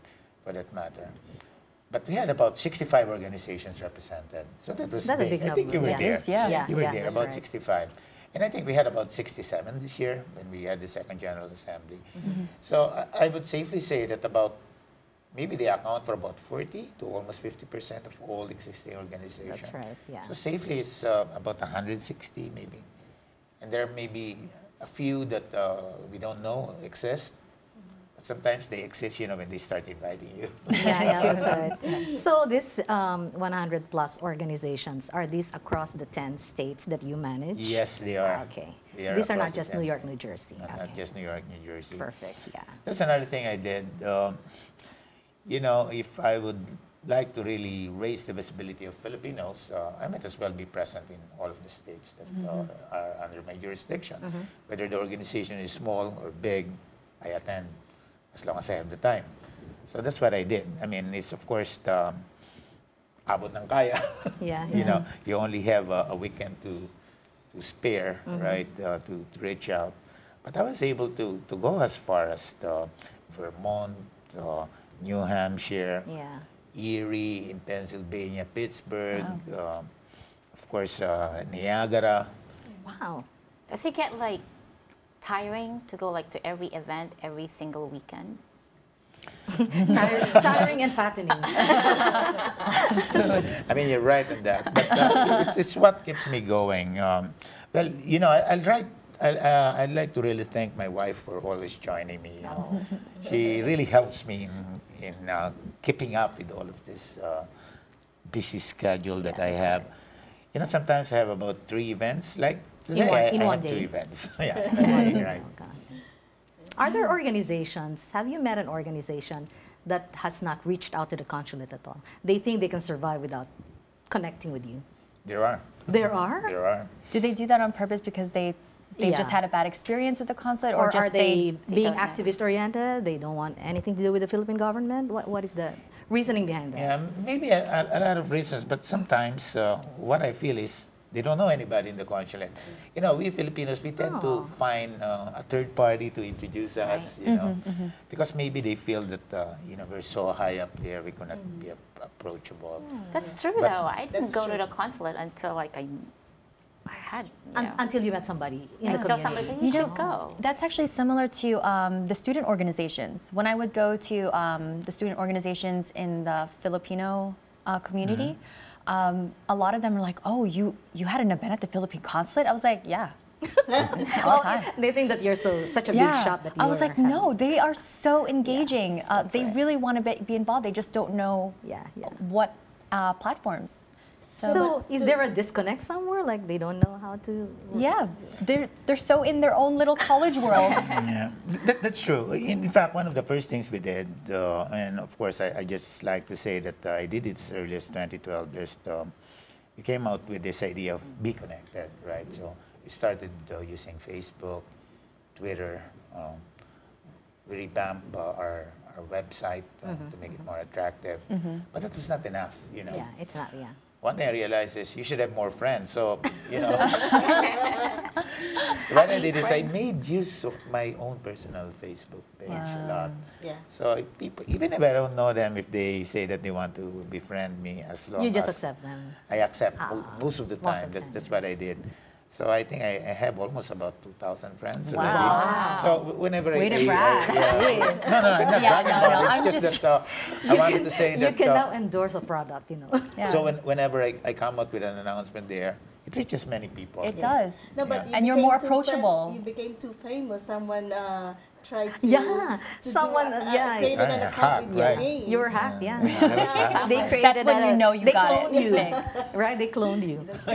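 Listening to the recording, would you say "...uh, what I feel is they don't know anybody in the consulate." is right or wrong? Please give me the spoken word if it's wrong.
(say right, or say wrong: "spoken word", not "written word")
right.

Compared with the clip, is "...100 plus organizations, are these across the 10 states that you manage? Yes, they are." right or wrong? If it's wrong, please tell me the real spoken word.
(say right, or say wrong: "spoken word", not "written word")
right.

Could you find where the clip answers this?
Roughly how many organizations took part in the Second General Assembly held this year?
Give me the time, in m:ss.
0:09.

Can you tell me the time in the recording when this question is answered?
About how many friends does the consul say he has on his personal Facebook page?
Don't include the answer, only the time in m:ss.
3:54.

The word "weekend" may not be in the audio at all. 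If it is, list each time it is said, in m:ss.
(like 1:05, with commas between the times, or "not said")
1:06, 1:27.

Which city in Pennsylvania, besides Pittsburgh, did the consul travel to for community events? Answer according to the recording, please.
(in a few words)
Erie.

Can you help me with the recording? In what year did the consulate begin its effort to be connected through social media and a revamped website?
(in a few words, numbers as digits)
2012.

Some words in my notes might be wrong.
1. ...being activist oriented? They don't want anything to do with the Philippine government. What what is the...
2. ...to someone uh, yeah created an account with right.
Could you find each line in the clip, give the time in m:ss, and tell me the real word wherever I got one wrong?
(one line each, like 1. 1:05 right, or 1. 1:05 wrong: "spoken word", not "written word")
1. 2:11 right
2. 4:12 right.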